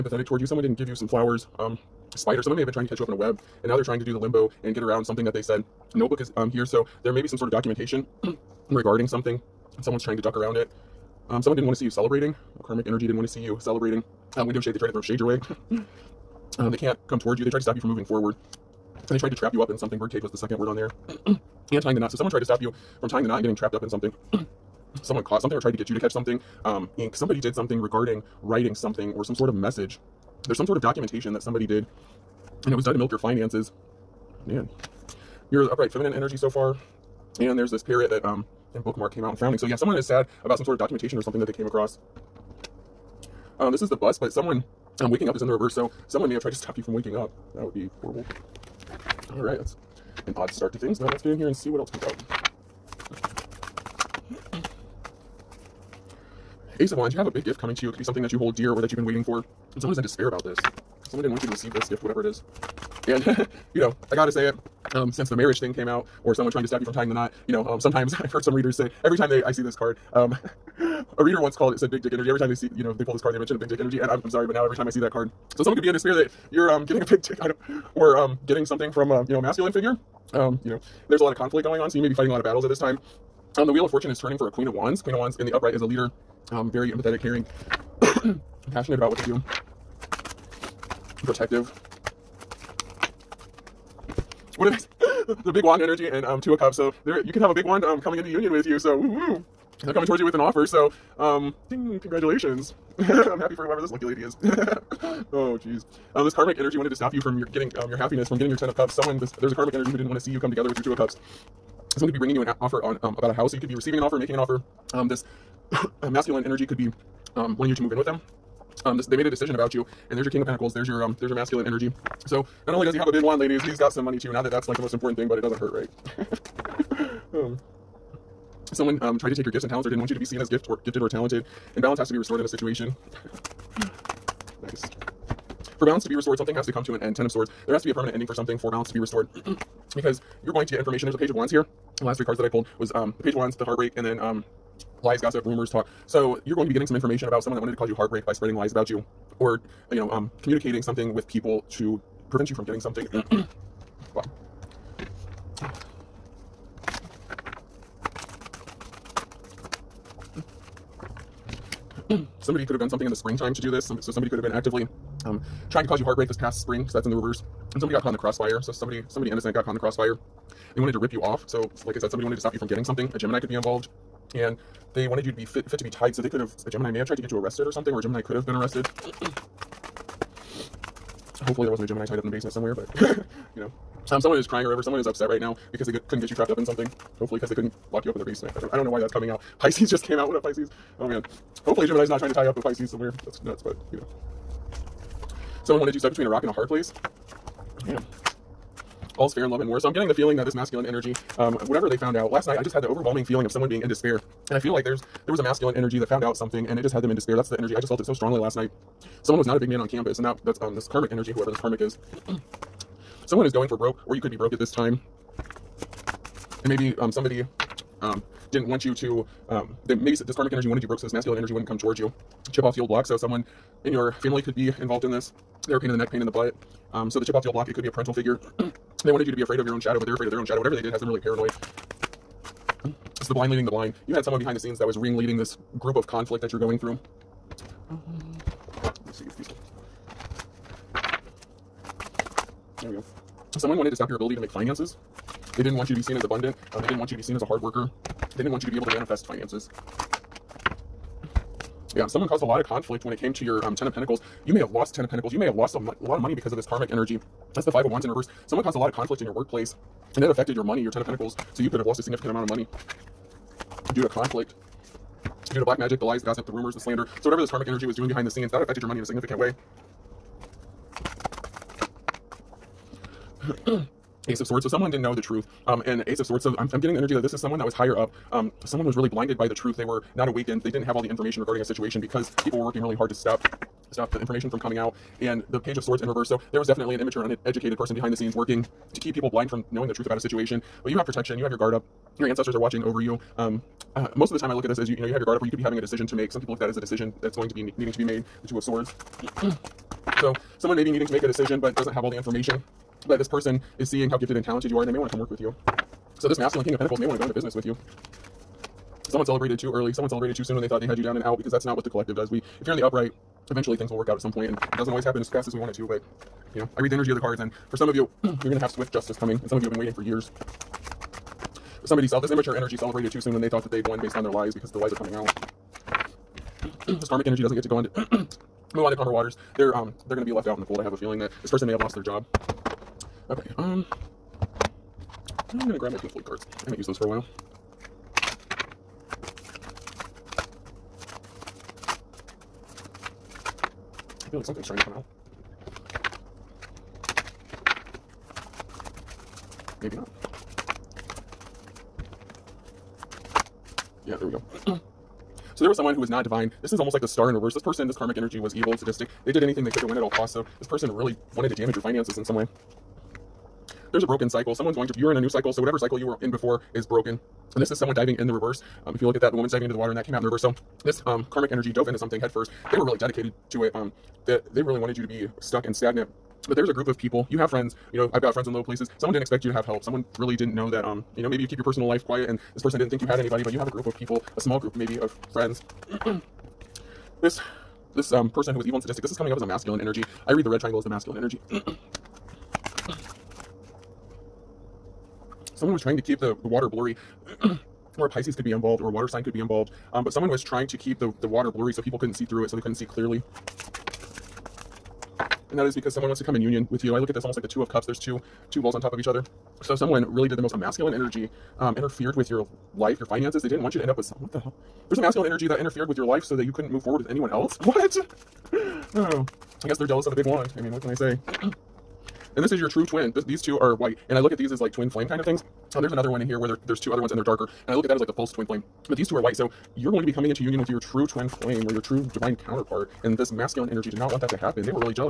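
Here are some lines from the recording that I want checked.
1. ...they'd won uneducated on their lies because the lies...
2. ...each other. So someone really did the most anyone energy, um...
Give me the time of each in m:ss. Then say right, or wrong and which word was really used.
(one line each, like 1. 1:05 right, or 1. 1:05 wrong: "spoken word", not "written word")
1. 5:23 wrong: "based", not "uneducated"
2. 6:48 wrong: "masculine", not "anyone".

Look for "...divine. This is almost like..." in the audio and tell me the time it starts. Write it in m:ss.
5:56.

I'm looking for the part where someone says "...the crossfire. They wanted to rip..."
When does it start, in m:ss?
2:49.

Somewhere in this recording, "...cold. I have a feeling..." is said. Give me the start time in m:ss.
5:30.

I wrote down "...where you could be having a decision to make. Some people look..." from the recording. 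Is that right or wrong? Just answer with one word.
right.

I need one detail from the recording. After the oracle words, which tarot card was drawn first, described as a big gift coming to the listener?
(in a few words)
Ace of Wands.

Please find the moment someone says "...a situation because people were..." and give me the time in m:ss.
4:41.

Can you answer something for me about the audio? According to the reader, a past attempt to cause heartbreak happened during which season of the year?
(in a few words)
Spring.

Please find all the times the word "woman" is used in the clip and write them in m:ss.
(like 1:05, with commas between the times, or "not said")
6:09.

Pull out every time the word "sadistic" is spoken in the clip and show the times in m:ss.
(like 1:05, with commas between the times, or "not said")
5:58, 6:28.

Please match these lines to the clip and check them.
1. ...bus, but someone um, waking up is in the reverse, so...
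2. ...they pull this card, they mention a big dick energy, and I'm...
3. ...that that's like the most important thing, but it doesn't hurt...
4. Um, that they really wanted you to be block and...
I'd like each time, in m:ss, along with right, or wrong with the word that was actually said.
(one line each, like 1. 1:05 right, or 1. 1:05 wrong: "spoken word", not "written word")
1. 0:43 right
2. 1:12 right
3. 2:04 right
4. 6:13 wrong: "stuck", not "block".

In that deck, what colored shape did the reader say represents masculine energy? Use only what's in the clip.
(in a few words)
Red triangle.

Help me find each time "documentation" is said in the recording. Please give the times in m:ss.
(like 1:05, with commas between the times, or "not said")
0:07, 0:30, 0:40.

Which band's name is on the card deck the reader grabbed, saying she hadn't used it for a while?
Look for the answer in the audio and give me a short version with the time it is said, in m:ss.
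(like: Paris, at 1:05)
Pink Floyd, at 5:35.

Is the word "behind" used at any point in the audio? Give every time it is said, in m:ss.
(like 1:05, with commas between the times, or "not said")
3:54, 4:28, 4:47.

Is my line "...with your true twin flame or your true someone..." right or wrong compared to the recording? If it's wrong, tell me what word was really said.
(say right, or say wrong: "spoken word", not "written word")
wrong: "divine", not "someone".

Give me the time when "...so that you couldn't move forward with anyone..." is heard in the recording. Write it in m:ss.
6:56.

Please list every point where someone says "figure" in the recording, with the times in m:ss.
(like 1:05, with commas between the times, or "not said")
1:19, 3:48.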